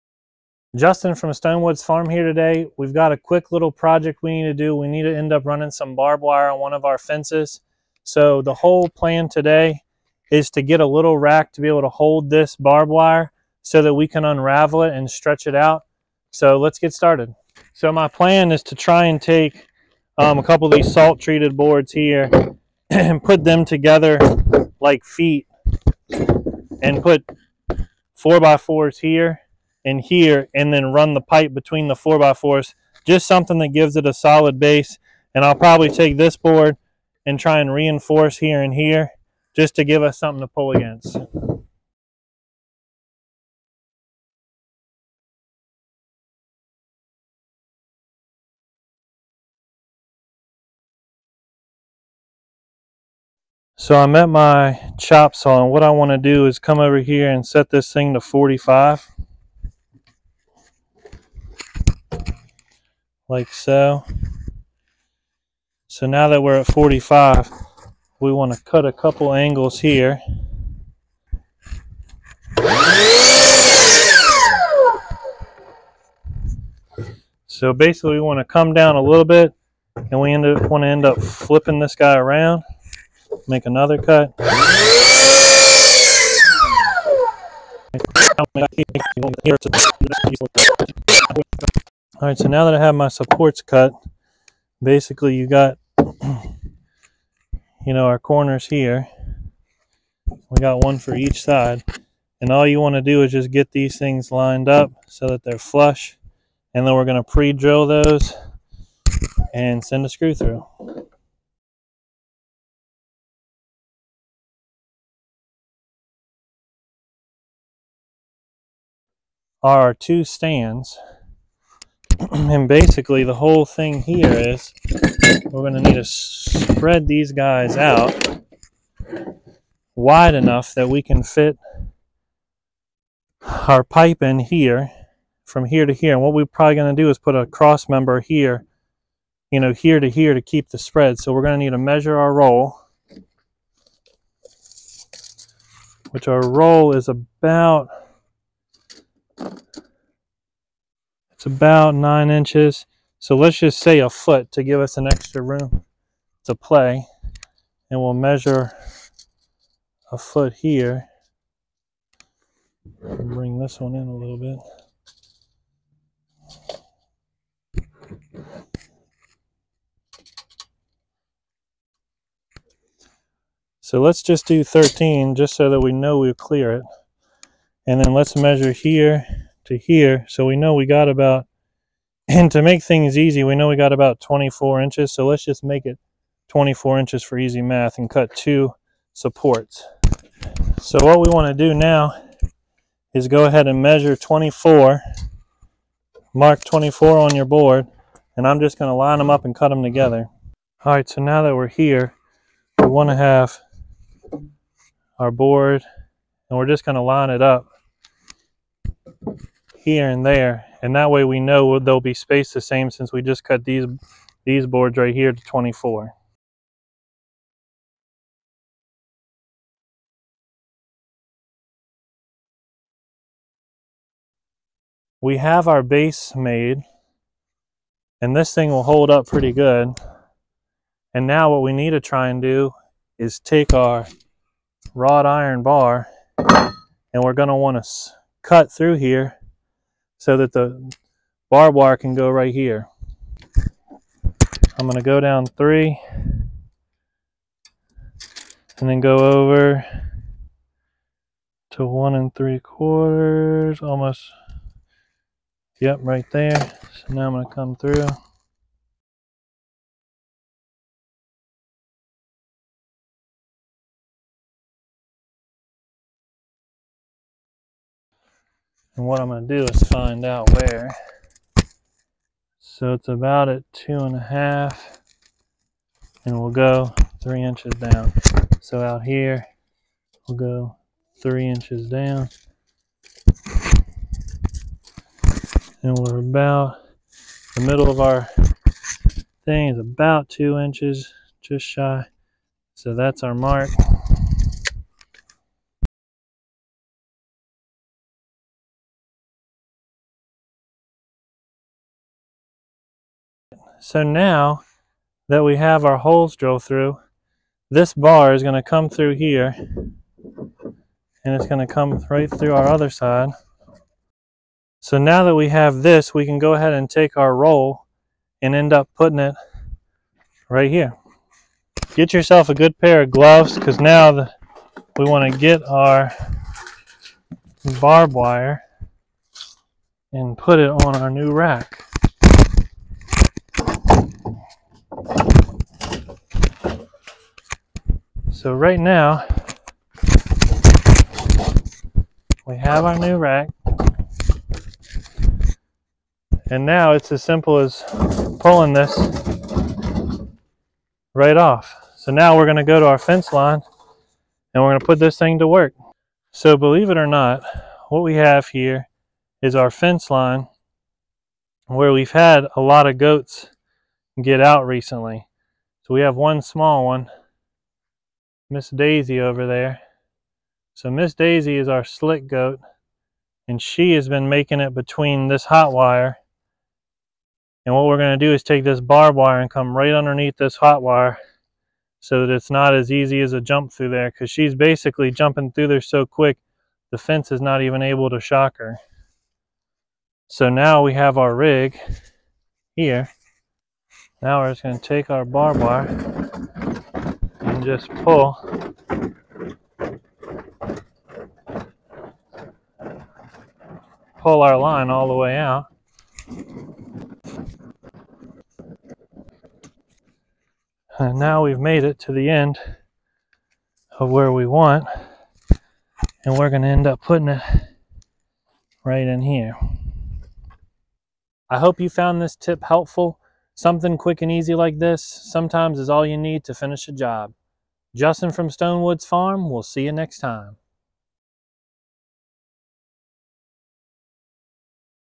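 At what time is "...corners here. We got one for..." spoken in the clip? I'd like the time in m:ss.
1:38.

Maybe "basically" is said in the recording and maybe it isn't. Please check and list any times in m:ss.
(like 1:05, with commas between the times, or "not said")
1:17, 1:34, 2:02, 6:24.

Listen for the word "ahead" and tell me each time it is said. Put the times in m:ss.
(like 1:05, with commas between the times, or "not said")
3:13, 5:16.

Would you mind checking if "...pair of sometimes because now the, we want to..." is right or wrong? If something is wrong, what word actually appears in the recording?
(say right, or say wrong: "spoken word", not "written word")
wrong: "gloves", not "sometimes".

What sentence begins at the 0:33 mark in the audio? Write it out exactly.
Just something that gives it a solid base.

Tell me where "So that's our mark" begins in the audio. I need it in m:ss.
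4:52.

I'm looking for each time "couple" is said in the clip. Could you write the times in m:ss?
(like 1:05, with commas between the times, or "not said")
0:20, 1:08.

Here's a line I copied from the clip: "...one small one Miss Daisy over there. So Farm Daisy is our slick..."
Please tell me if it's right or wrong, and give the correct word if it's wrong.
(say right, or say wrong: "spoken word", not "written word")
wrong: "Miss", not "Farm".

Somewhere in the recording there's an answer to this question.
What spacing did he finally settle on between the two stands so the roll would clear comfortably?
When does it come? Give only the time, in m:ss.
2:54.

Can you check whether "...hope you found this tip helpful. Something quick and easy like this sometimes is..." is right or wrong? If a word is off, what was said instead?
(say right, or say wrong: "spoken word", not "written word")
right.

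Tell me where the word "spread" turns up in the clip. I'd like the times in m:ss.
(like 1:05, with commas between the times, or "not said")
2:06, 2:20.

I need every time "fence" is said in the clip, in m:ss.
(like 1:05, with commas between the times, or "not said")
0:06, 5:52, 5:59, 6:26.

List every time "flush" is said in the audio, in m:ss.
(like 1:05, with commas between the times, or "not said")
1:45.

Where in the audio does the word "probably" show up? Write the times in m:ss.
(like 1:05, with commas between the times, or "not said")
0:35, 2:16.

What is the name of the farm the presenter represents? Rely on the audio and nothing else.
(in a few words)
Stonewoods Farm.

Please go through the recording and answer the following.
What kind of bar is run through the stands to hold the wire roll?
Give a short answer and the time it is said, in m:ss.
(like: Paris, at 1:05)
wrought iron bar, at 3:54.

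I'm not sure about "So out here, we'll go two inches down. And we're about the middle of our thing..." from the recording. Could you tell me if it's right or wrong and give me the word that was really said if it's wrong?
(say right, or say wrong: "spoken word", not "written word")
wrong: "three", not "two".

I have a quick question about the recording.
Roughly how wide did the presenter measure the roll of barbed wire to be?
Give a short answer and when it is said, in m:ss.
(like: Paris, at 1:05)
9 inches, at 2:31.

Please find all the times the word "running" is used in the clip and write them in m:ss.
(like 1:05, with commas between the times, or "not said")
0:05.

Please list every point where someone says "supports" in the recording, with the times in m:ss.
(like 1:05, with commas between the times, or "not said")
1:33, 3:09.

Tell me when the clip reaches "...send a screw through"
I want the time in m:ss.
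1:49.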